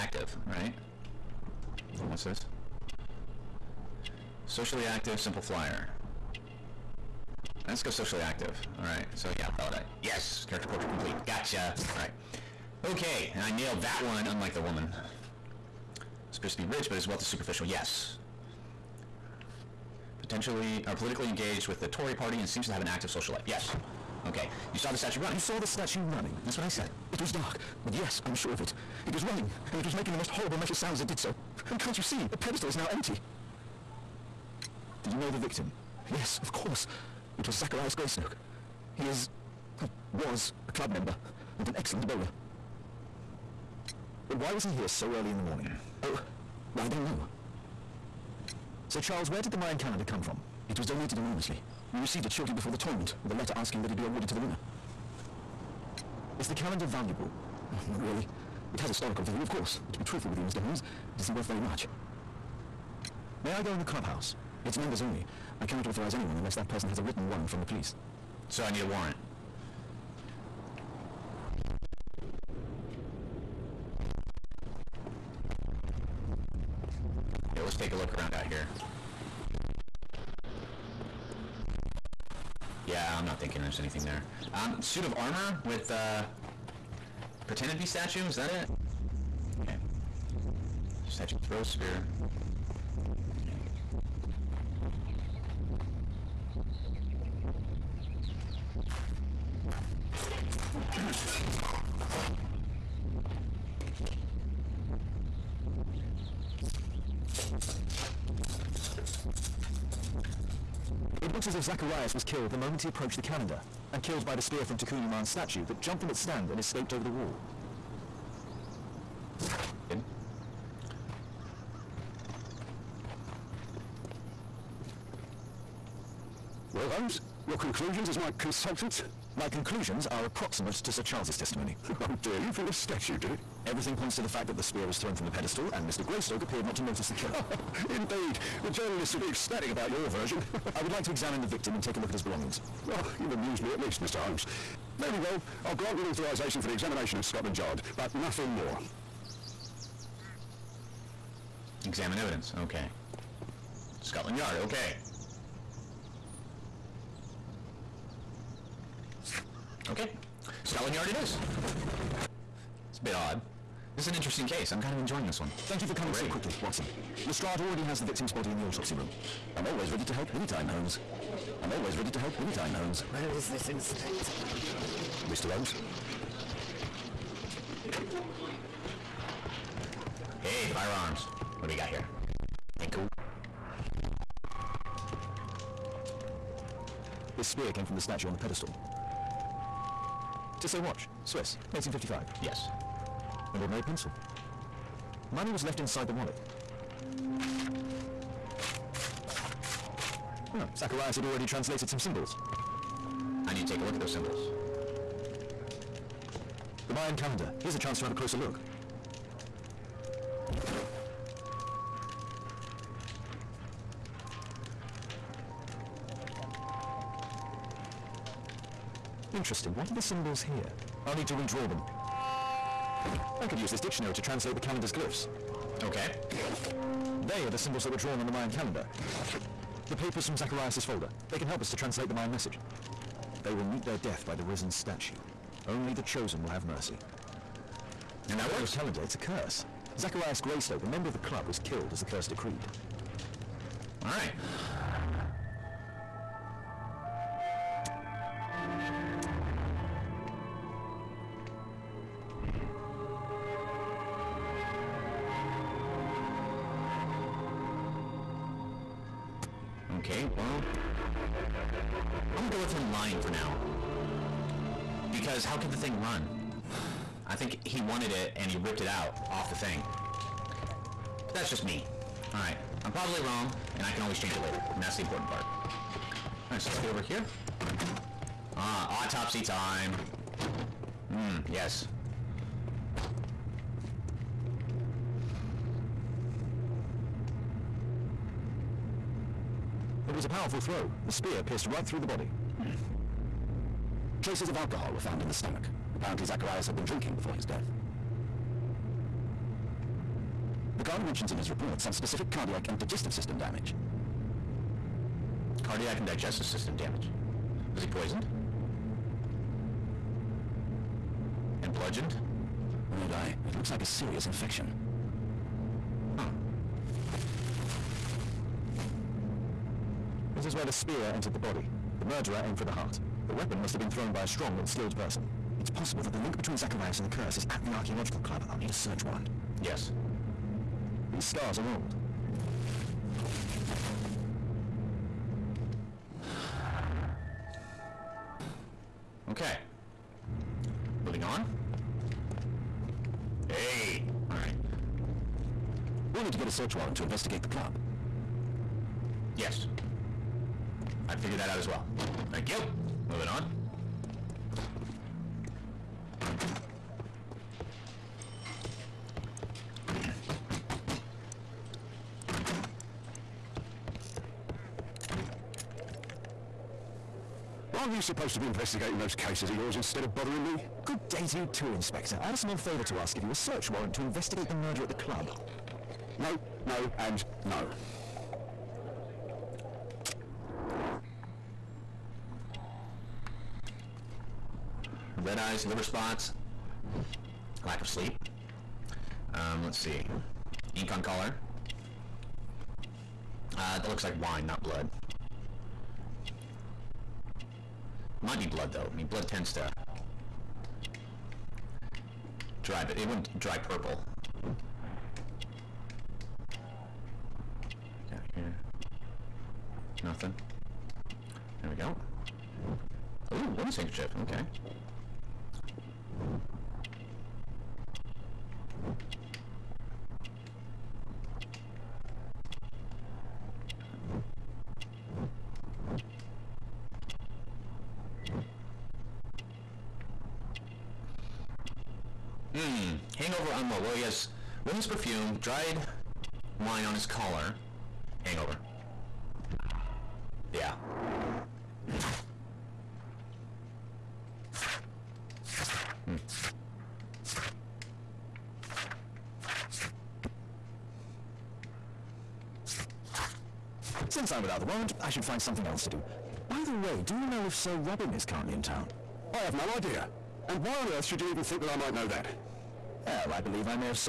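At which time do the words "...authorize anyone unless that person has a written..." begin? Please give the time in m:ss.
1:05.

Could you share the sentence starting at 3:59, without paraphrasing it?
Zacharias Greystoke, a member of the club, was killed as the curse decreed.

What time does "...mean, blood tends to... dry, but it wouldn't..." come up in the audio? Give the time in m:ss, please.
6:38.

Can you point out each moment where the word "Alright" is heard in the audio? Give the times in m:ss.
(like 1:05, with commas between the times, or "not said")
4:32, 4:36, 5:44.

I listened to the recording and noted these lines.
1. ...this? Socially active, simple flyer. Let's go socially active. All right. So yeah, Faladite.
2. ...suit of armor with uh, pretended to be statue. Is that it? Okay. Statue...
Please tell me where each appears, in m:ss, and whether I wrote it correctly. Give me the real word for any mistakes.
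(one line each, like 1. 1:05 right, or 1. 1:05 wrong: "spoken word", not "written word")
1. 0:02 right
2. 1:24 right.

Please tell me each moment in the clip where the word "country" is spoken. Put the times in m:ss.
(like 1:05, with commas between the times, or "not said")
not said.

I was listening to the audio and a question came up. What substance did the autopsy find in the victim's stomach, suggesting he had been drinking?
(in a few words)
Alcohol.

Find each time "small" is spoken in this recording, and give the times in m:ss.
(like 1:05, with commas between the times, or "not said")
6:12.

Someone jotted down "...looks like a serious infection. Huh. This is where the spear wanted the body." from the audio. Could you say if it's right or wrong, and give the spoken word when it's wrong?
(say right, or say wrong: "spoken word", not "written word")
wrong: "entered", not "wanted".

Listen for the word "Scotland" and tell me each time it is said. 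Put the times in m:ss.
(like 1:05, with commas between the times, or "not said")
2:27, 2:34, 2:40.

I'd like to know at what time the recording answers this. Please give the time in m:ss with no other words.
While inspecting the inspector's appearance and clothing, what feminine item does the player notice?
6:53.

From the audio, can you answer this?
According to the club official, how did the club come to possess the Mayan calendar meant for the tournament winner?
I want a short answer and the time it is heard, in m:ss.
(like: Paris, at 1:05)
Donated anonymously, at 0:50.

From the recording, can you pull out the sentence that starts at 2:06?
Well, Holmes, your conclusions as my consultant?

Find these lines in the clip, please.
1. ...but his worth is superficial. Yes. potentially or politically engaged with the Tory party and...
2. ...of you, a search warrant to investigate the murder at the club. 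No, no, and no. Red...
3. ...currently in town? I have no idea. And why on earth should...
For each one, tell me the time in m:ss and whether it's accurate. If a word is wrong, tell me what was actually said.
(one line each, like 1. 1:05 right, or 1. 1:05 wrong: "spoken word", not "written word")
1. 0:16 wrong: "wealth", not "worth"
2. 6:13 right
3. 7:38 right.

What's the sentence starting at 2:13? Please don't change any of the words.
Everything points to the fact that the spear was thrown from the pedestal, and Mr.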